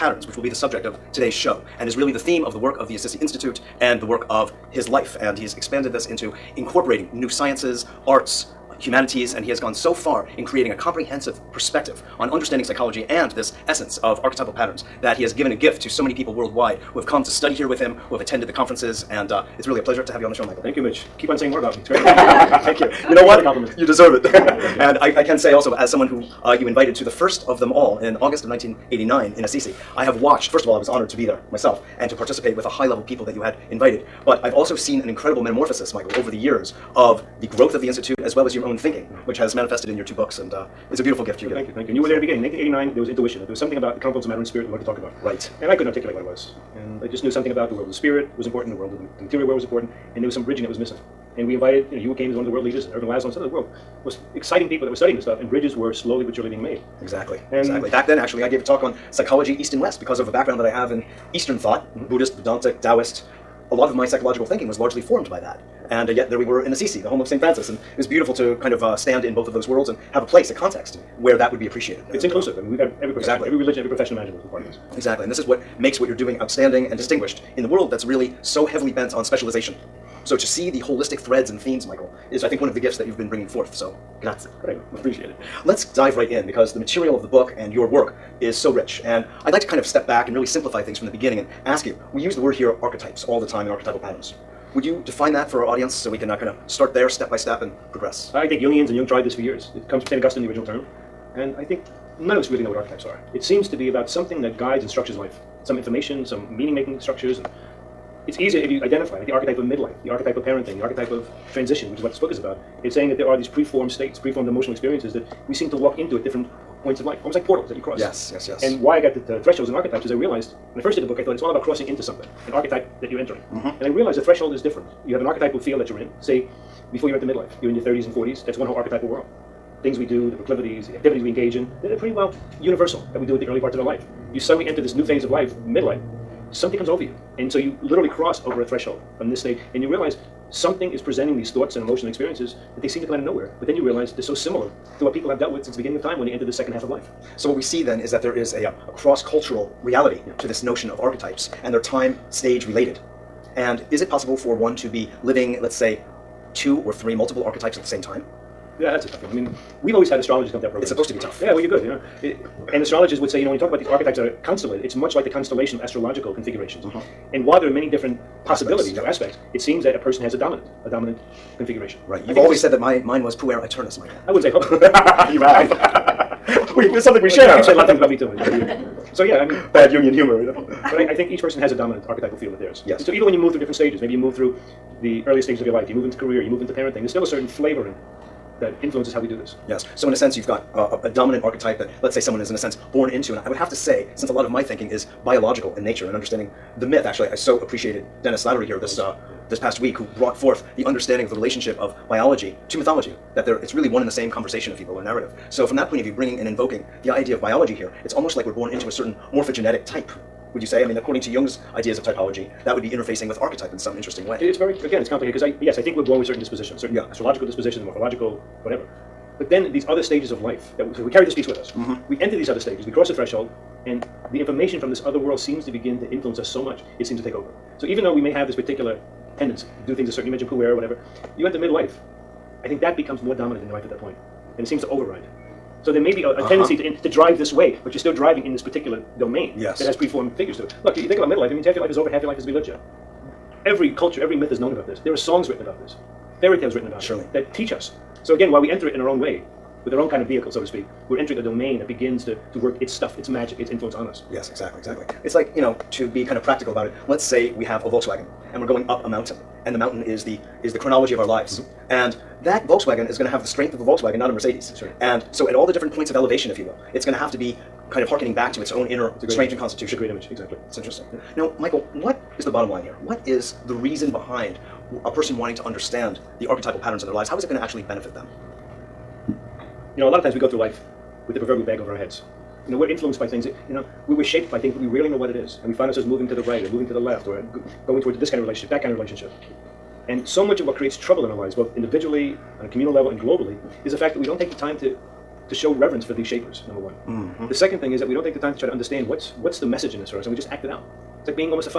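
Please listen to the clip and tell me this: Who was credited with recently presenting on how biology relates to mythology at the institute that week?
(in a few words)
Dennis Slattery.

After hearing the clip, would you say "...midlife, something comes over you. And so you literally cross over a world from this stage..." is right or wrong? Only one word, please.
wrong.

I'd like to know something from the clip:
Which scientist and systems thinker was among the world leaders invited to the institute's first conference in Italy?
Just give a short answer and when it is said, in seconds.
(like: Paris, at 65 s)
Ervin Laszlo, at 52 s.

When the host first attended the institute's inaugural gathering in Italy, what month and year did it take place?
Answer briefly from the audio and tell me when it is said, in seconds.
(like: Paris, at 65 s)
August 1989, at 28 s.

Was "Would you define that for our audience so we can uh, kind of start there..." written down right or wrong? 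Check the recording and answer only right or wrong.
right.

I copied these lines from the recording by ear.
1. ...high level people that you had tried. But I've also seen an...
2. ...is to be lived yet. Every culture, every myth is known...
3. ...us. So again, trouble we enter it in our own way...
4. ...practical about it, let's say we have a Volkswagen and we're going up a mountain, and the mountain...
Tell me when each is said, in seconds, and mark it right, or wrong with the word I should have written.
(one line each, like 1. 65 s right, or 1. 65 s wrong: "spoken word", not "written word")
1. 32 s wrong: "invited", not "tried"
2. 242 s right
3. 247 s wrong: "while", not "trouble"
4. 256 s right.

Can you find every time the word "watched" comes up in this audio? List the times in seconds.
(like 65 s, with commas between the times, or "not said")
30 s.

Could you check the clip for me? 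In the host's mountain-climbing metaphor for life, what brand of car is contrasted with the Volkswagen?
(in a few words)
Mercedes.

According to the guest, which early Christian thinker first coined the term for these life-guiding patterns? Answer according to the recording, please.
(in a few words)
St. Augustine.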